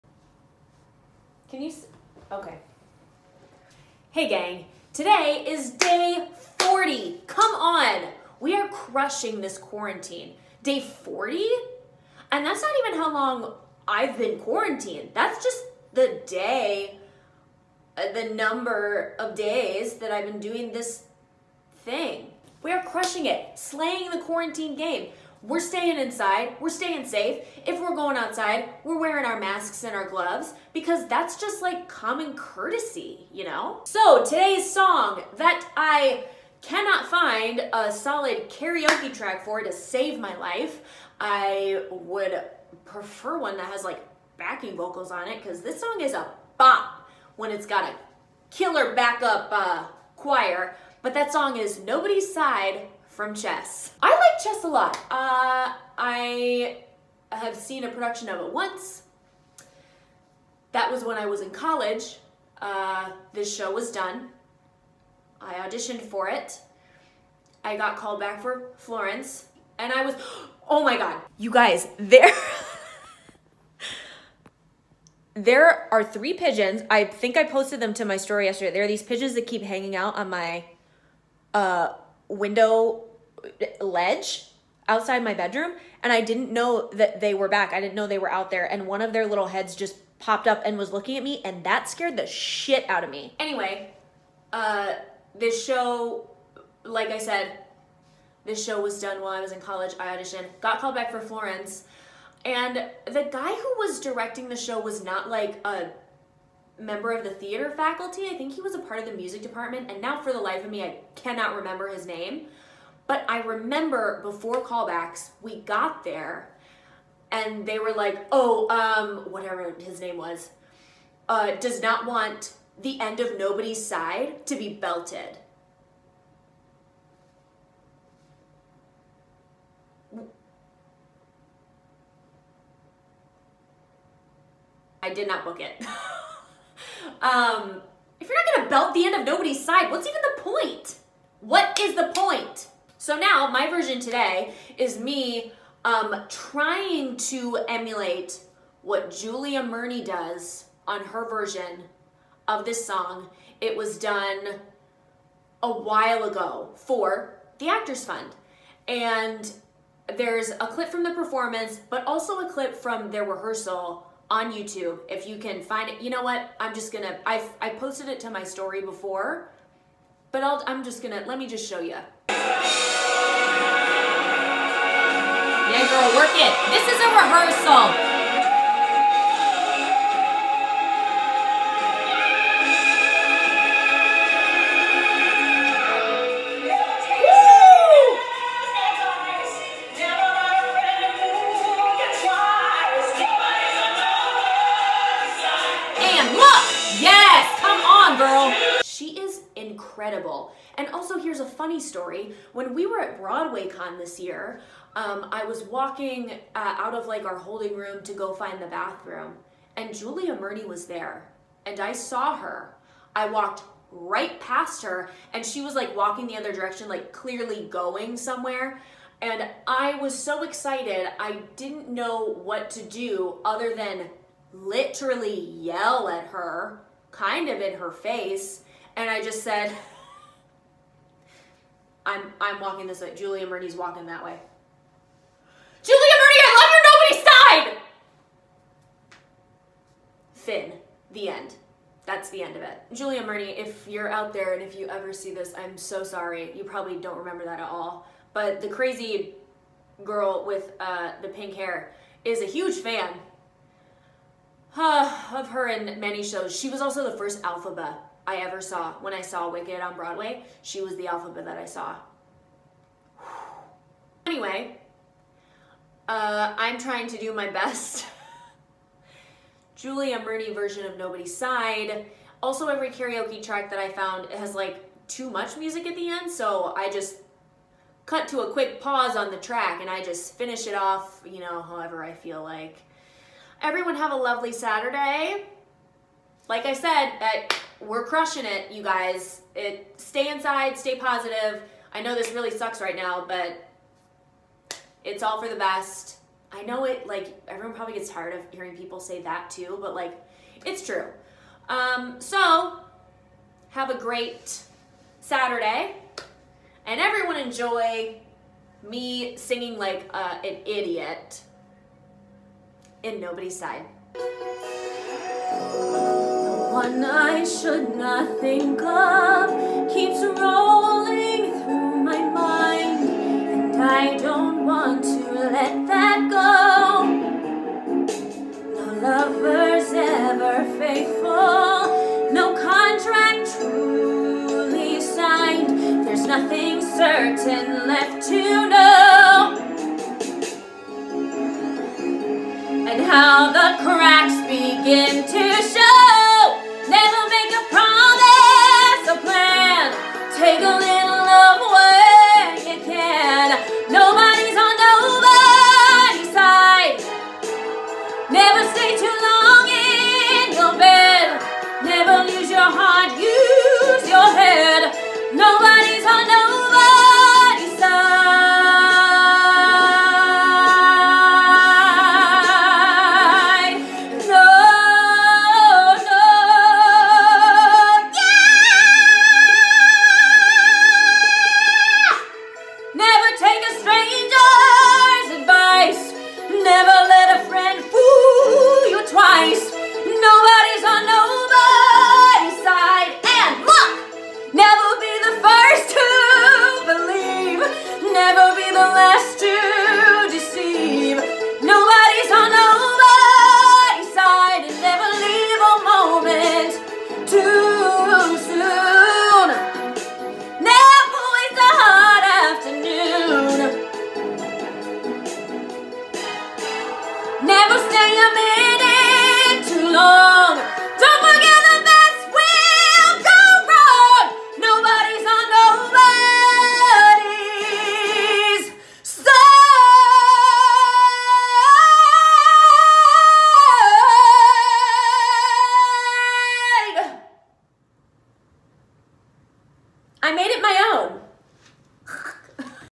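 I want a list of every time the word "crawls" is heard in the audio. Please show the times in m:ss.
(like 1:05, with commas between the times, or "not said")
not said.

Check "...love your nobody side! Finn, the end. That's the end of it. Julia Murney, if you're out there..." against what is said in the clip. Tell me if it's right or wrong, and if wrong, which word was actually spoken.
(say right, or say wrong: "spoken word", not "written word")
right.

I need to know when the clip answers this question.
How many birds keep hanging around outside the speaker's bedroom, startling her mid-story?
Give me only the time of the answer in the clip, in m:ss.
1:16.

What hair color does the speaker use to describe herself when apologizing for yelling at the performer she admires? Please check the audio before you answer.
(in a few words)
pink.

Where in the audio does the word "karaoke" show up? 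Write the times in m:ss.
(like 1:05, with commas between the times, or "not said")
0:38, 4:32.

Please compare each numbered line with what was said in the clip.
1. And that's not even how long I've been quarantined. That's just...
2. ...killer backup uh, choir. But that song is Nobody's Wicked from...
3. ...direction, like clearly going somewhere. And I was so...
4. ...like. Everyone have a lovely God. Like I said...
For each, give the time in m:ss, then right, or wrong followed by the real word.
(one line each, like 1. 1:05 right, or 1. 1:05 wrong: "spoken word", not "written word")
1. 0:12 right
2. 0:48 wrong: "Side", not "Wicked"
3. 3:36 right
4. 4:42 wrong: "Saturday", not "God".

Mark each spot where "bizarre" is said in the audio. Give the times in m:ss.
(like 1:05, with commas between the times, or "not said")
not said.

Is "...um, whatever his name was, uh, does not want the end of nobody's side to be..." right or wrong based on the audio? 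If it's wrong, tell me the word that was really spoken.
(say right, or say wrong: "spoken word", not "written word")
right.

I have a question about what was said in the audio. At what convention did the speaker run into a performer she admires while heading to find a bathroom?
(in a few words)
Broadway Con.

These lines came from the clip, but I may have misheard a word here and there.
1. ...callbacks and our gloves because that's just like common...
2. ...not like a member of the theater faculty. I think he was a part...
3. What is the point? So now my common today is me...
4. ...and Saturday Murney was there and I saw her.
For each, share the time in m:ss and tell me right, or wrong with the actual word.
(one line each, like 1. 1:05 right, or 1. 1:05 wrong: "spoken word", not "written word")
1. 0:29 wrong: "masks", not "callbacks"
2. 1:45 right
3. 2:21 wrong: "version", not "common"
4. 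3:29 wrong: "Julia", not "Saturday".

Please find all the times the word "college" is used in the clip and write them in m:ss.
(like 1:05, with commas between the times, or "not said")
1:01, 1:39.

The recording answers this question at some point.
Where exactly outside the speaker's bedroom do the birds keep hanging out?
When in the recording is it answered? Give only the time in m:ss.
1:22.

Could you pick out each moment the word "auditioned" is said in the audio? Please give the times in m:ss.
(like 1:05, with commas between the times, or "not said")
1:05, 1:40.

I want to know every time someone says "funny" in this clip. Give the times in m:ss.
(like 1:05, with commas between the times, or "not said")
3:21.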